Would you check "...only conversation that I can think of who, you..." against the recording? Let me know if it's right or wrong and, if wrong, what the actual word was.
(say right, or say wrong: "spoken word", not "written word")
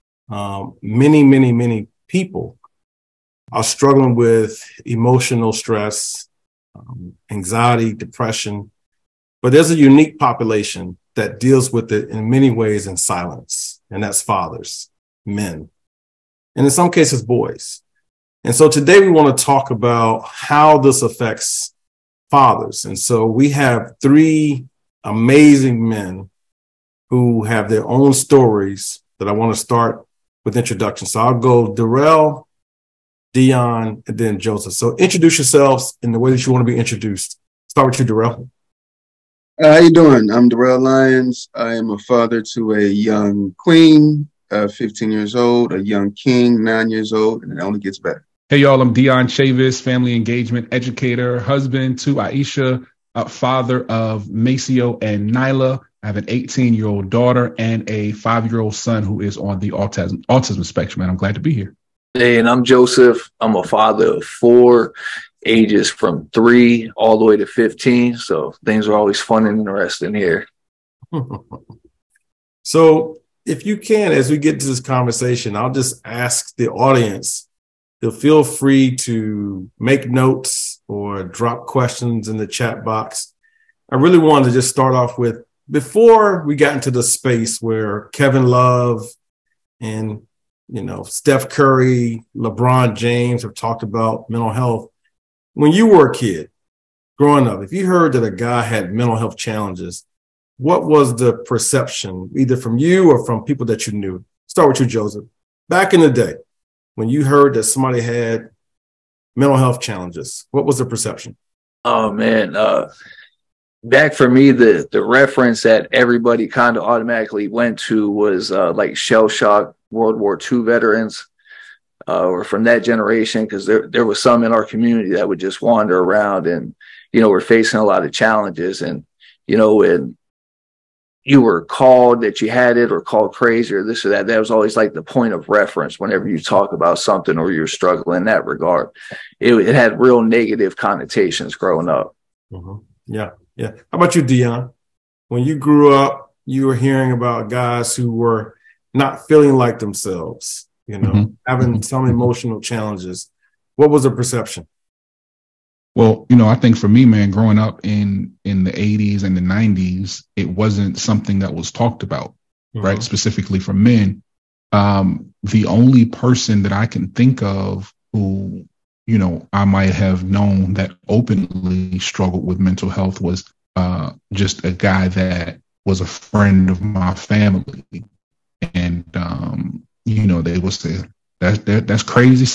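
wrong: "person", not "conversation".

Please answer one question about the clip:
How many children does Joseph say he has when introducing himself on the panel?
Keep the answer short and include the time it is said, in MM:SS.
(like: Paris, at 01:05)
4, at 01:04.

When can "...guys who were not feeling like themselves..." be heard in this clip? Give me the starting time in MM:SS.
02:27.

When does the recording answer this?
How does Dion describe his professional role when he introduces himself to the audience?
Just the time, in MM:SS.
00:49.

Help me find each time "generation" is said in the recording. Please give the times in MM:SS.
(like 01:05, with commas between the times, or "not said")
02:02.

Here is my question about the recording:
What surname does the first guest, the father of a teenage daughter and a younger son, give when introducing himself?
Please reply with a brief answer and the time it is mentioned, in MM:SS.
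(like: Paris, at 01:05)
Lyons, at 00:40.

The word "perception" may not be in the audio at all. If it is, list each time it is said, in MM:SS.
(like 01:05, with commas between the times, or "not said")
01:41, 01:50, 02:34.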